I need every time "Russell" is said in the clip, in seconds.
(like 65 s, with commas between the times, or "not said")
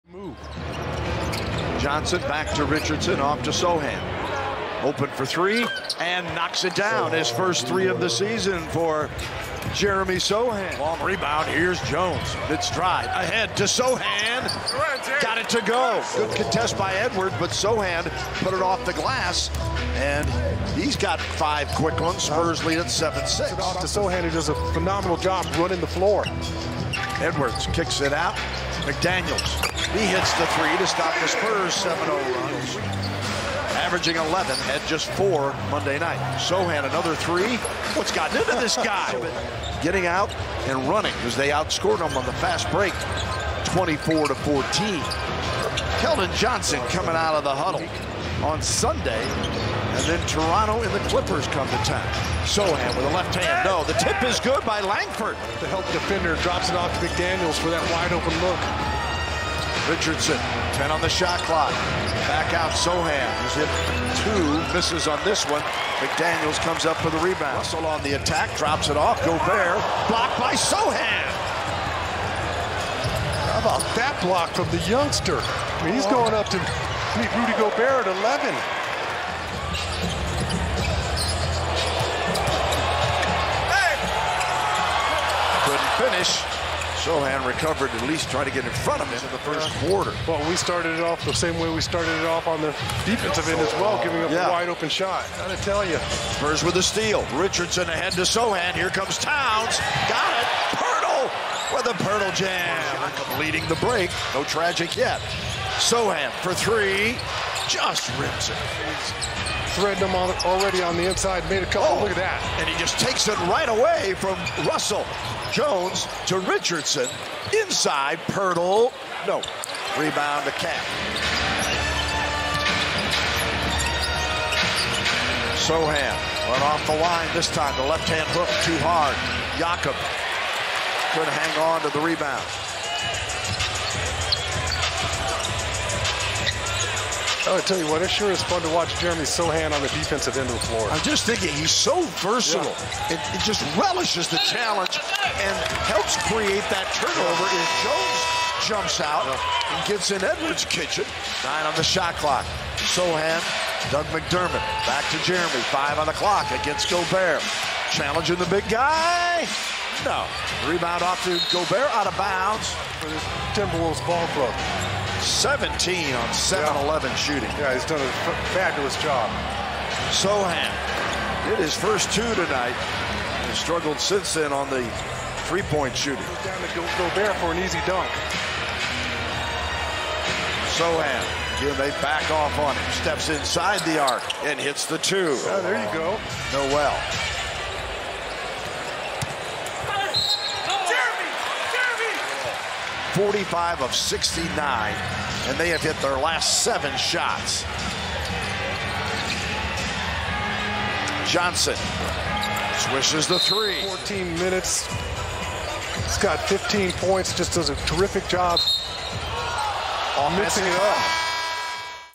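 67 s, 114 s.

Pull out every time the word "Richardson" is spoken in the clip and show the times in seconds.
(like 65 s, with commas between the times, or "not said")
2 s, 59 s, 97 s, 116 s.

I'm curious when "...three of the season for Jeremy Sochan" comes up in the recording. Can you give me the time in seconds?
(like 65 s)
7 s.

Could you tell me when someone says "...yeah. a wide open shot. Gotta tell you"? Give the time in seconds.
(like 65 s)
94 s.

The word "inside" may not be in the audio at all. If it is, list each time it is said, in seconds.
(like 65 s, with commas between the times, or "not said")
111 s, 117 s, 183 s.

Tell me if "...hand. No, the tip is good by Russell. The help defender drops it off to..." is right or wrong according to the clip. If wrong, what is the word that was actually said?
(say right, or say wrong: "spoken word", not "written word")
wrong: "Langford", not "Russell".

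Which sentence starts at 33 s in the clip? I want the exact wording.
Averaging 11, had just four Monday night.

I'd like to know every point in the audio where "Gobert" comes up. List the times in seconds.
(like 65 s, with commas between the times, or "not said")
69 s, 77 s, 156 s, 161 s, 176 s.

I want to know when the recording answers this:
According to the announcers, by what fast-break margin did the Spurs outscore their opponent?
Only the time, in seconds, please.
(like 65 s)
43 s.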